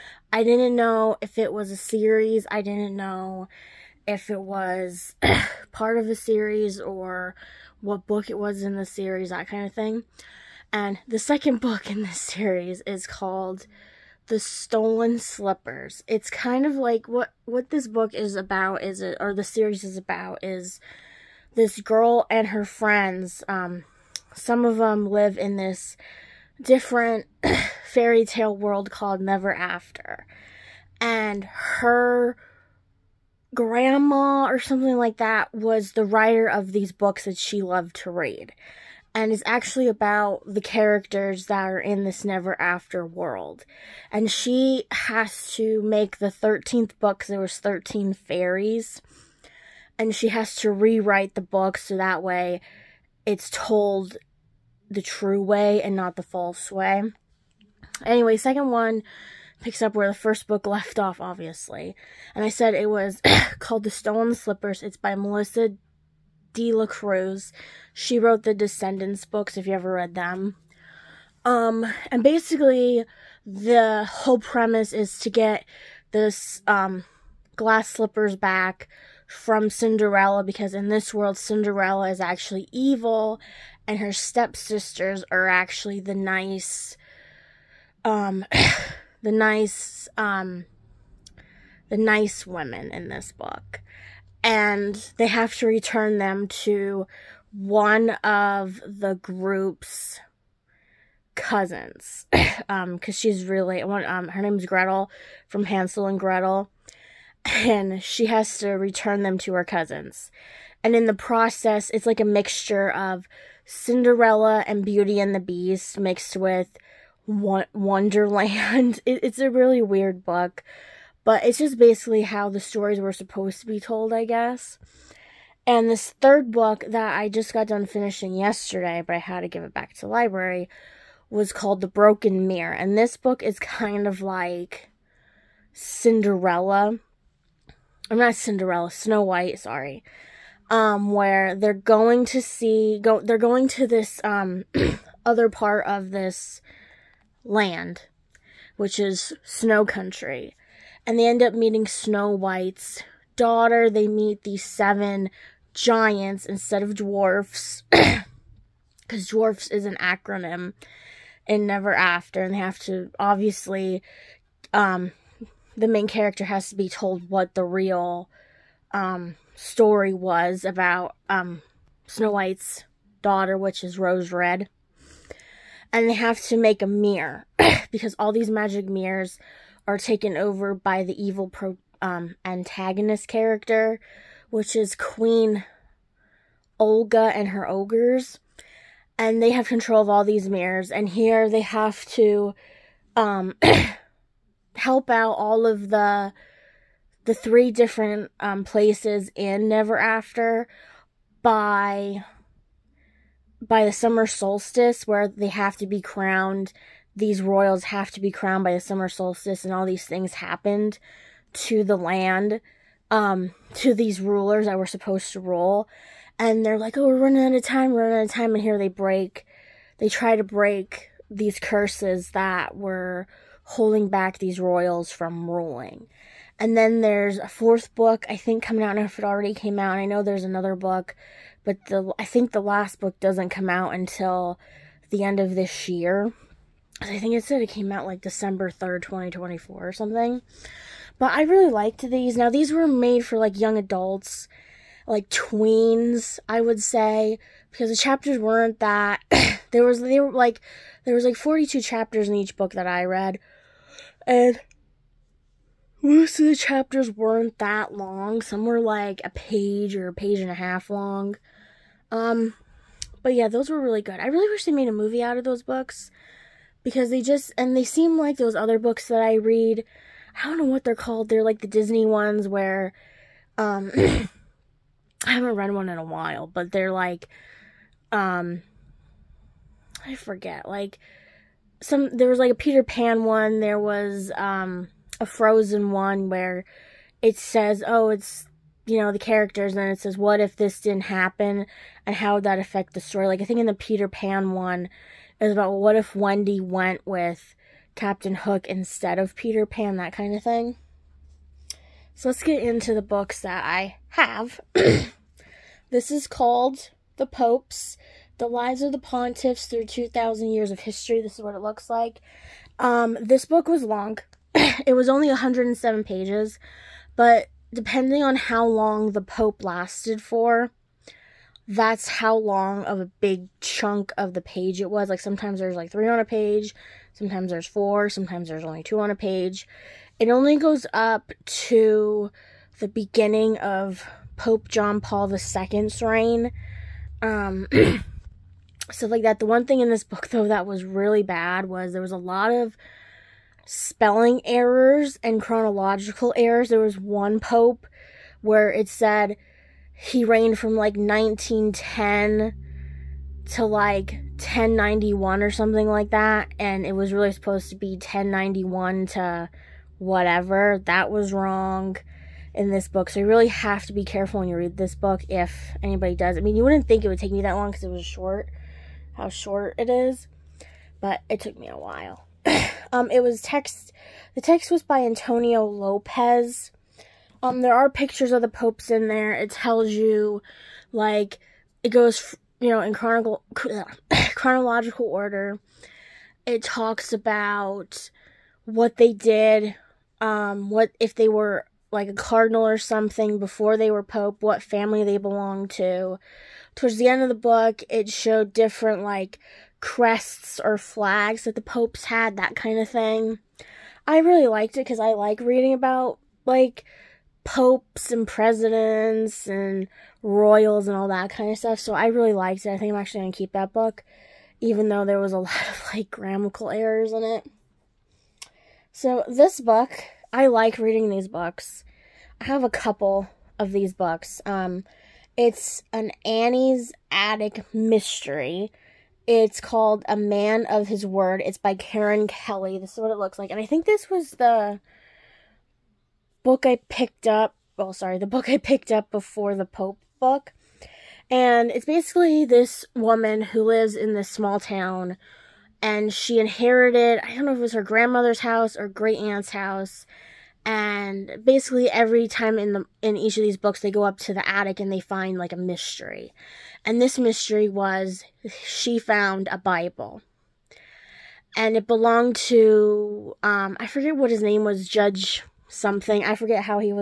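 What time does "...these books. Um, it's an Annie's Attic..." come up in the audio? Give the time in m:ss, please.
7:03.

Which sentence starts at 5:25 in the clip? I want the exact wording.
Like sometimes there's like three on a page, sometimes there's four, sometimes there's only two on a page.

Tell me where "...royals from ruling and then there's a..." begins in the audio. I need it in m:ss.
3:44.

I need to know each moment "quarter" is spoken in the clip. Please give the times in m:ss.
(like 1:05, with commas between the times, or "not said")
not said.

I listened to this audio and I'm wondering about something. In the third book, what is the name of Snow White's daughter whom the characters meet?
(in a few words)
Rose Red.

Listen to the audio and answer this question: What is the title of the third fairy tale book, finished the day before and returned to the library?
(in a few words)
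The Broken Mirror.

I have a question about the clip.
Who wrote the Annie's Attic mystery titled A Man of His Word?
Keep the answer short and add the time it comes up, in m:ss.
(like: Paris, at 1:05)
Karen Kelly, at 7:11.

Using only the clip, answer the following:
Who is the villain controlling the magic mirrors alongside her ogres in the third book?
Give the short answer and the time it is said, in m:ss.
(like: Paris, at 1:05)
Queen Olga, at 3:04.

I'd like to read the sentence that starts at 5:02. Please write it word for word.
So let's get into the books that I have.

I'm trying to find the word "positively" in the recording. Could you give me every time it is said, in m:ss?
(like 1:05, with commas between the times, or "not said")
not said.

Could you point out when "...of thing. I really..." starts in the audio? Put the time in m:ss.
6:42.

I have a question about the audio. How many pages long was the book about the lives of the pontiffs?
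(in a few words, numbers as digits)
107.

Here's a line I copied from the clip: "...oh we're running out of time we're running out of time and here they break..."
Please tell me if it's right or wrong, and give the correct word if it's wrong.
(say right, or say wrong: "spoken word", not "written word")
right.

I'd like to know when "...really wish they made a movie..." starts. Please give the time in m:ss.
4:24.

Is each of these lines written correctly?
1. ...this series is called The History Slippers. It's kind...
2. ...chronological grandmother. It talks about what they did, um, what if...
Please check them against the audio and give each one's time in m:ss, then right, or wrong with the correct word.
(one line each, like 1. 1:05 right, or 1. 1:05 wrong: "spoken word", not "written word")
1. 0:12 wrong: "Stolen", not "History"
2. 6:24 wrong: "order", not "grandmother".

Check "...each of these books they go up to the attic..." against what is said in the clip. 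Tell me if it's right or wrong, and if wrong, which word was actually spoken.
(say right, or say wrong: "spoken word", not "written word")
right.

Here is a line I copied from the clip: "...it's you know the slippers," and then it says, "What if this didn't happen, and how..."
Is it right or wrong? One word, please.
wrong.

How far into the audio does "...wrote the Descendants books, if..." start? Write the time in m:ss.
1:08.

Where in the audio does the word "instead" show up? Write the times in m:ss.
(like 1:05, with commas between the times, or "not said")
2:36, 4:58.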